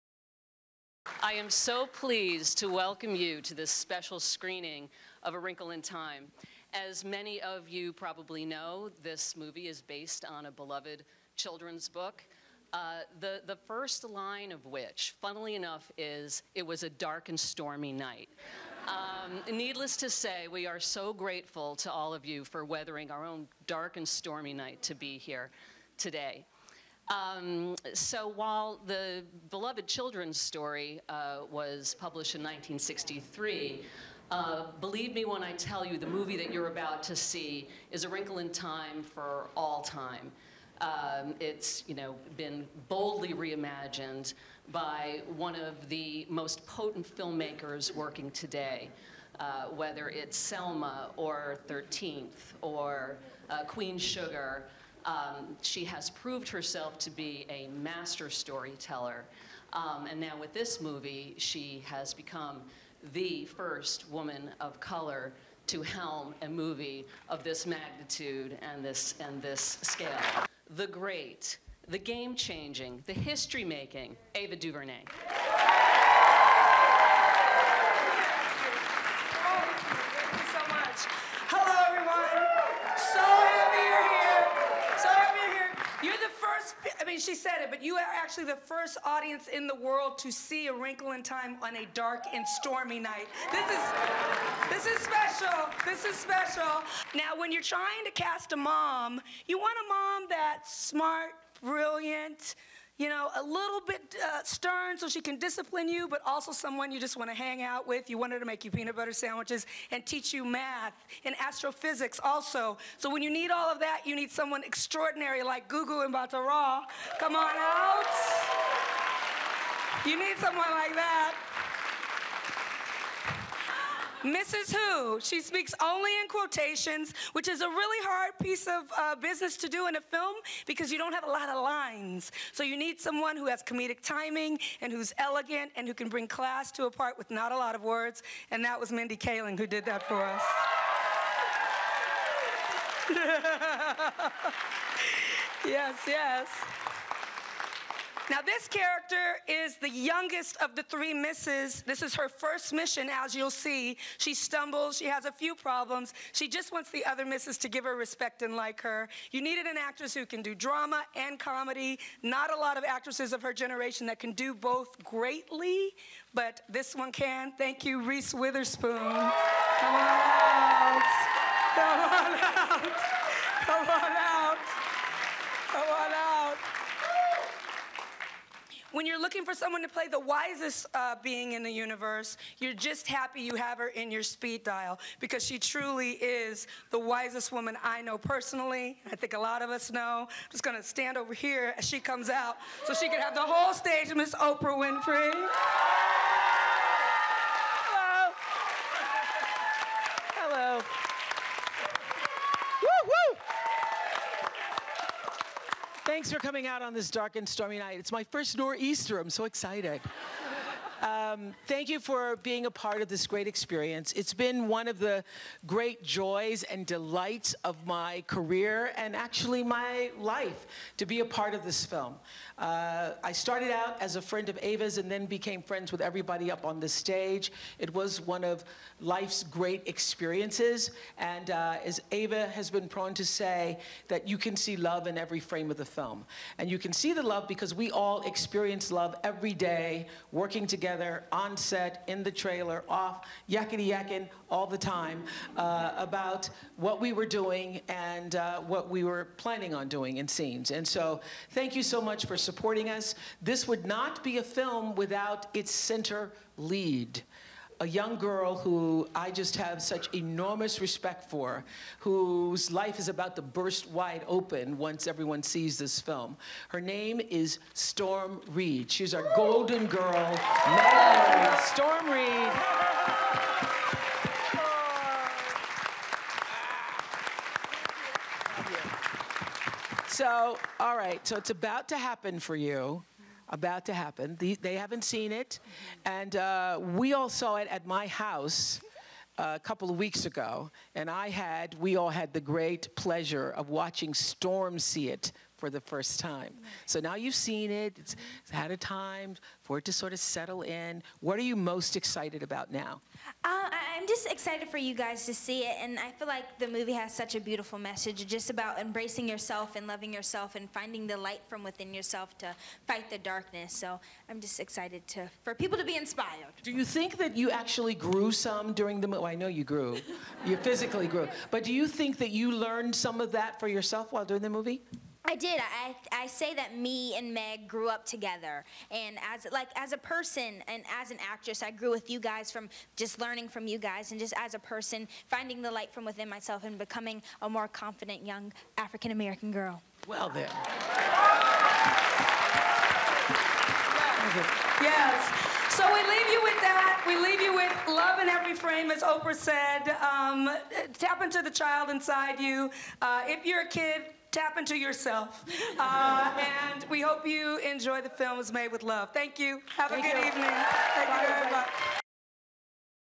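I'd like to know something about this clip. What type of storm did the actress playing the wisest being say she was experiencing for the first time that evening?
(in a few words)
nor'easter.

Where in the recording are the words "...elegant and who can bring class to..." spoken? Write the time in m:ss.
2:15.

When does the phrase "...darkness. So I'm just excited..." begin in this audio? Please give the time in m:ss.
5:13.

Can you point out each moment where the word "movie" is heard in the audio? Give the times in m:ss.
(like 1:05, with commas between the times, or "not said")
0:09, 0:36, 1:00, 1:06, 5:06, 5:19, 5:24.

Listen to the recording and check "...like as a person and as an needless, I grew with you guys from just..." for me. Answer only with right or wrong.
wrong.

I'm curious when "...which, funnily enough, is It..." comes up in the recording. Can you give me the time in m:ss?
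0:14.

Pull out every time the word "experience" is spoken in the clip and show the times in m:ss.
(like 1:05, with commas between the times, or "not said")
3:33, 3:49, 3:58.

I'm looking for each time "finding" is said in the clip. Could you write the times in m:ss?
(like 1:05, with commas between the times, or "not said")
5:10, 5:35.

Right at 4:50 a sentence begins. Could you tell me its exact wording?
And I had, we all had the great pleasure of watching Storm see it for the first time.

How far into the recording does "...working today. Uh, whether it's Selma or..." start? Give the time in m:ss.
0:47.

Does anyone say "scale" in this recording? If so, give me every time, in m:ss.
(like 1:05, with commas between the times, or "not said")
1:09.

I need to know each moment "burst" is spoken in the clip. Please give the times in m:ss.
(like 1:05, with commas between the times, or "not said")
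4:23.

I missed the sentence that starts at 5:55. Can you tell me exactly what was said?
Uh, and we hope you enjoy the films made with love.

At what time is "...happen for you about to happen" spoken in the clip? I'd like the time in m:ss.
4:41.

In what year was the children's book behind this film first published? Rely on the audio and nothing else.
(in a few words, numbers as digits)
1963.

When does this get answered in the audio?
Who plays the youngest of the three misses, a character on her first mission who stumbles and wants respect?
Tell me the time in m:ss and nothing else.
2:48.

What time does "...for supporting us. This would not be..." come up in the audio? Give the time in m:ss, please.
4:12.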